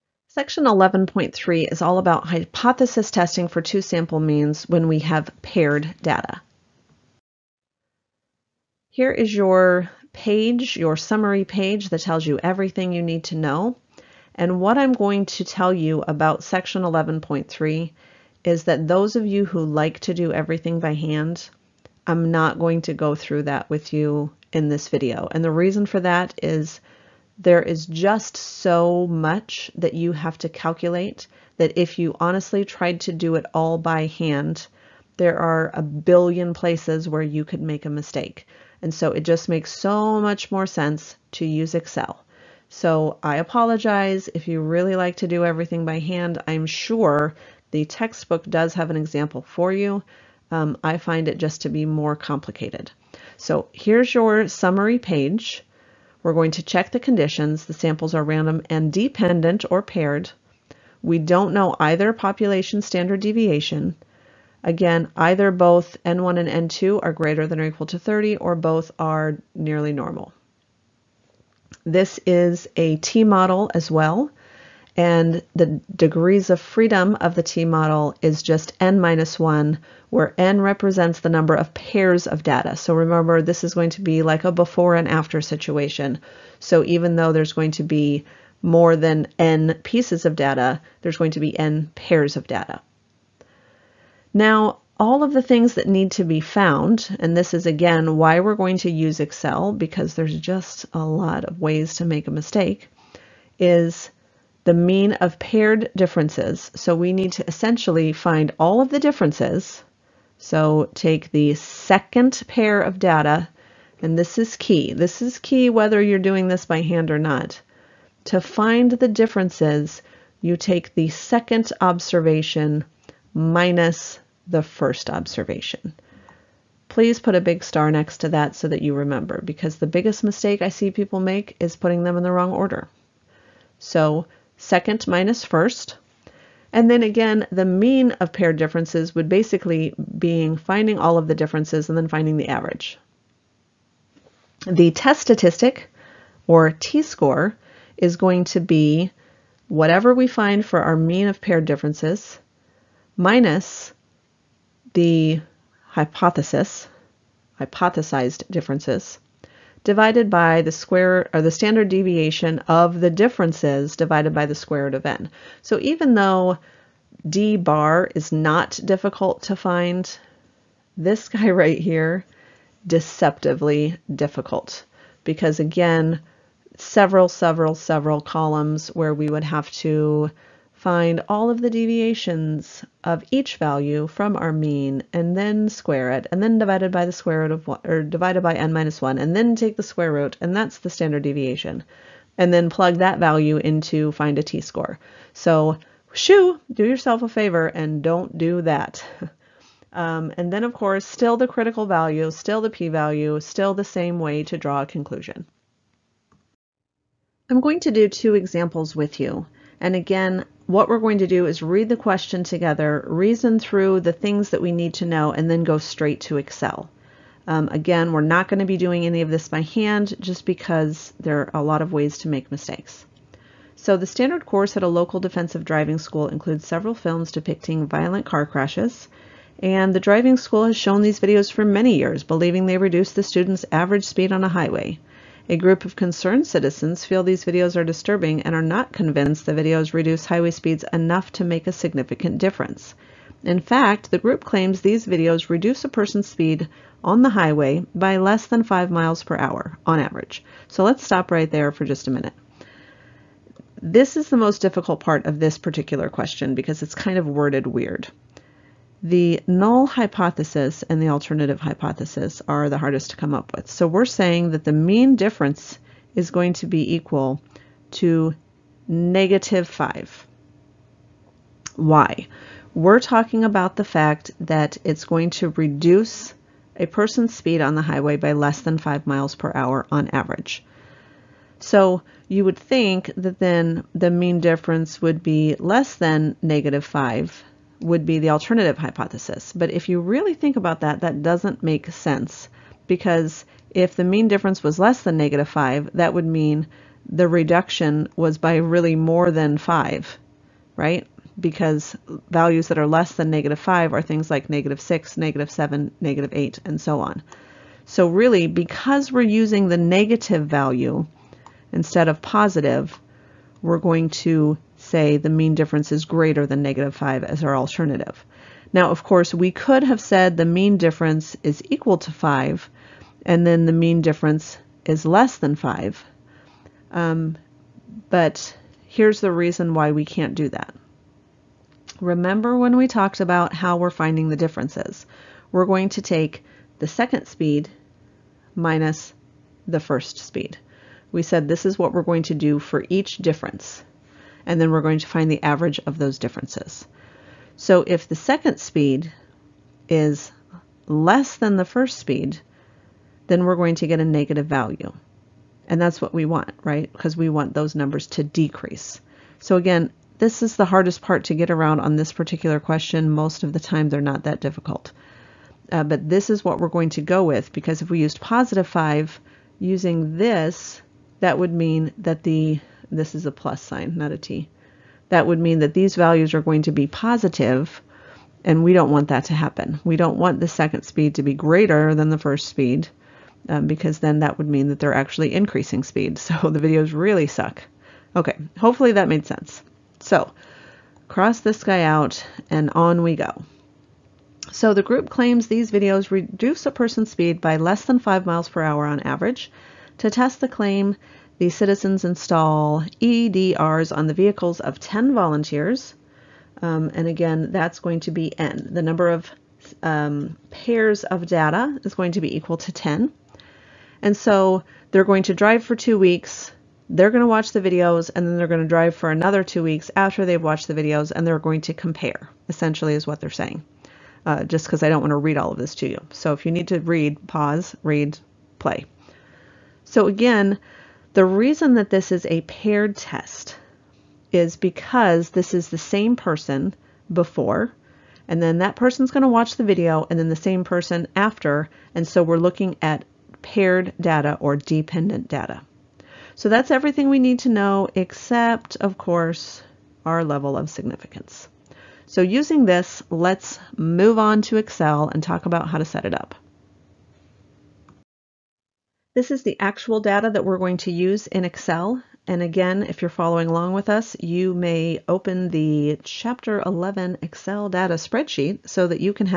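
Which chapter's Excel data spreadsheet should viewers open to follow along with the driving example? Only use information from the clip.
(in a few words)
Chapter 11.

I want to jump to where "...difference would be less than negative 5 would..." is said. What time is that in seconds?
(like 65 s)
284 s.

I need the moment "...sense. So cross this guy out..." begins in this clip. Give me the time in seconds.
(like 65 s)
389 s.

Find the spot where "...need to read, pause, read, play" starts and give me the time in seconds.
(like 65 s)
426 s.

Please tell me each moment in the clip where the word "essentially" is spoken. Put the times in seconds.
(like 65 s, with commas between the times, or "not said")
107 s, 422 s.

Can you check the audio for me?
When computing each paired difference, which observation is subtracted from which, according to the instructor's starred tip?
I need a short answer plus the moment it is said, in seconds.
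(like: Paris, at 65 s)
second minus first, at 121 s.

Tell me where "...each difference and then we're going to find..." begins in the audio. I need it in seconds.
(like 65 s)
342 s.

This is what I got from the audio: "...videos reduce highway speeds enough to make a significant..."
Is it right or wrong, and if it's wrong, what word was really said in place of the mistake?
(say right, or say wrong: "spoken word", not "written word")
right.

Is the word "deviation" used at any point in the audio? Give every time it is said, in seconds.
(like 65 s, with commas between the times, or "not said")
63 s, 161 s, 181 s, 191 s.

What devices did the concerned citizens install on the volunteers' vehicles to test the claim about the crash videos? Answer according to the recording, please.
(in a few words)
EDRs.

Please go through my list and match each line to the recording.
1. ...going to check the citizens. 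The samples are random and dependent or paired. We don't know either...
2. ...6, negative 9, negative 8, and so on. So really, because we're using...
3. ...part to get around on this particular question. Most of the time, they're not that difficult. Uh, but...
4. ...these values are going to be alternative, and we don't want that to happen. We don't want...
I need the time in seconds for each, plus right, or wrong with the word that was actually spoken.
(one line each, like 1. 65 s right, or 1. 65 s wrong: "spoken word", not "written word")
1. 56 s wrong: "conditions", not "citizens"
2. 304 s wrong: "7", not "9"
3. 361 s right
4. 375 s wrong: "positive", not "alternative".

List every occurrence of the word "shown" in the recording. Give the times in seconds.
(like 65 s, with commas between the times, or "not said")
230 s.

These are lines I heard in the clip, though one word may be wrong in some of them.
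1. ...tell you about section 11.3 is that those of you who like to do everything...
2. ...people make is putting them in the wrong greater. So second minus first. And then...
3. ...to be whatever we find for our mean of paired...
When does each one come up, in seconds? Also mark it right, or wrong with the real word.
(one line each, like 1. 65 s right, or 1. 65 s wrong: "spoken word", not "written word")
1. 15 s right
2. 130 s wrong: "order", not "greater"
3. 148 s right.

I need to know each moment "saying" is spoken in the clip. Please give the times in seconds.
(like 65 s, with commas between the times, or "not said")
264 s, 423 s.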